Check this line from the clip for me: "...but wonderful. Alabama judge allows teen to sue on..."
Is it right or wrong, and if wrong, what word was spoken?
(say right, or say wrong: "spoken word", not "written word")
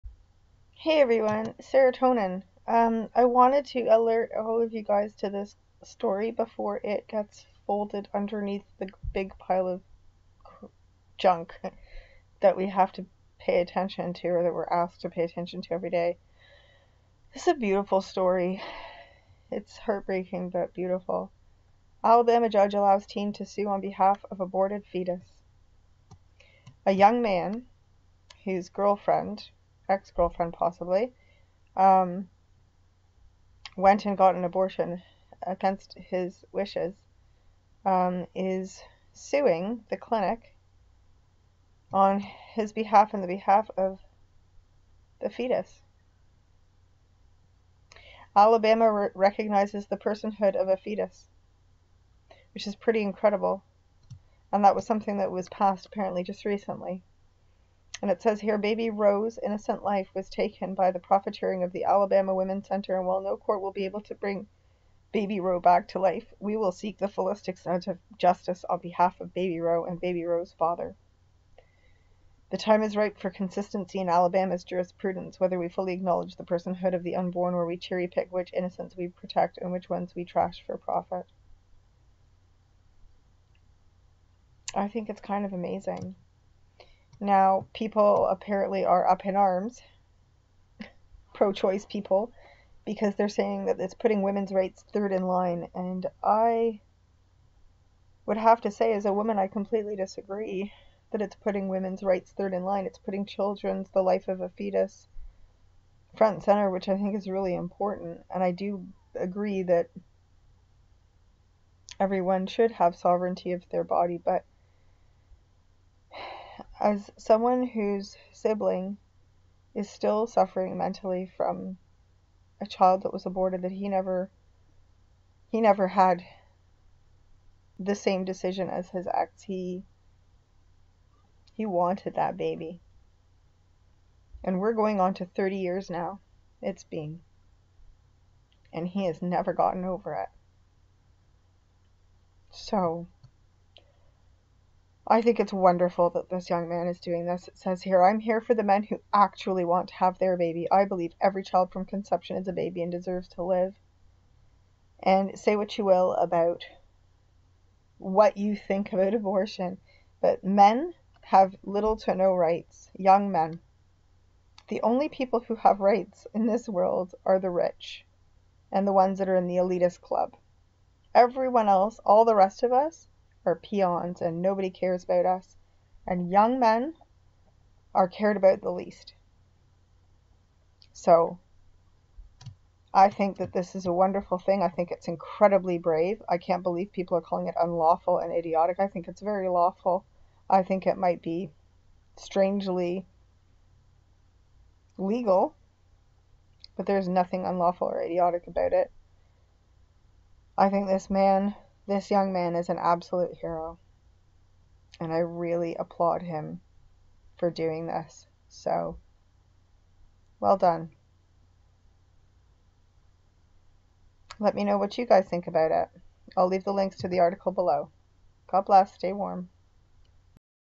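wrong: "beautiful", not "wonderful".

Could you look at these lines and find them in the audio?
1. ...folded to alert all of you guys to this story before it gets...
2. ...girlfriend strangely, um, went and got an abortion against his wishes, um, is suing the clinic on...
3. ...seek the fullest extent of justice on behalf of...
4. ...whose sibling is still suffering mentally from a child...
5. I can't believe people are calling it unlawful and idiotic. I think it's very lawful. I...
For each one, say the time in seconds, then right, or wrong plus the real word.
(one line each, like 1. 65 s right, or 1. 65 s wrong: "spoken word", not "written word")
1. 3 s wrong: "wanted", not "folded"
2. 30 s wrong: "possibly", not "strangely"
3. 66 s right
4. 117 s right
5. 186 s right.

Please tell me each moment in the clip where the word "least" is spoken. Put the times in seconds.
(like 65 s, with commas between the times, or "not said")
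178 s.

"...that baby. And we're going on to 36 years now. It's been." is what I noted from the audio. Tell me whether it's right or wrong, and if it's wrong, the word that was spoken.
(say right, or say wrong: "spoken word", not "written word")
wrong: "30", not "36".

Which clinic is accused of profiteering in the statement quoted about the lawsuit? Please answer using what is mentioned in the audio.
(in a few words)
Alabama Women's Center.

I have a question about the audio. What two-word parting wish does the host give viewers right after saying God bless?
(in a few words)
Stay warm.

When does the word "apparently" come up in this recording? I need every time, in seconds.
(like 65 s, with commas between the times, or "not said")
55 s, 88 s.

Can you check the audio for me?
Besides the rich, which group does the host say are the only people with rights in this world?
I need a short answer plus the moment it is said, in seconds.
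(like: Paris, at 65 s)
the elitist club, at 169 s.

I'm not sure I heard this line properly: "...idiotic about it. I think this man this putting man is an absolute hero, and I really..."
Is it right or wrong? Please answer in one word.
wrong.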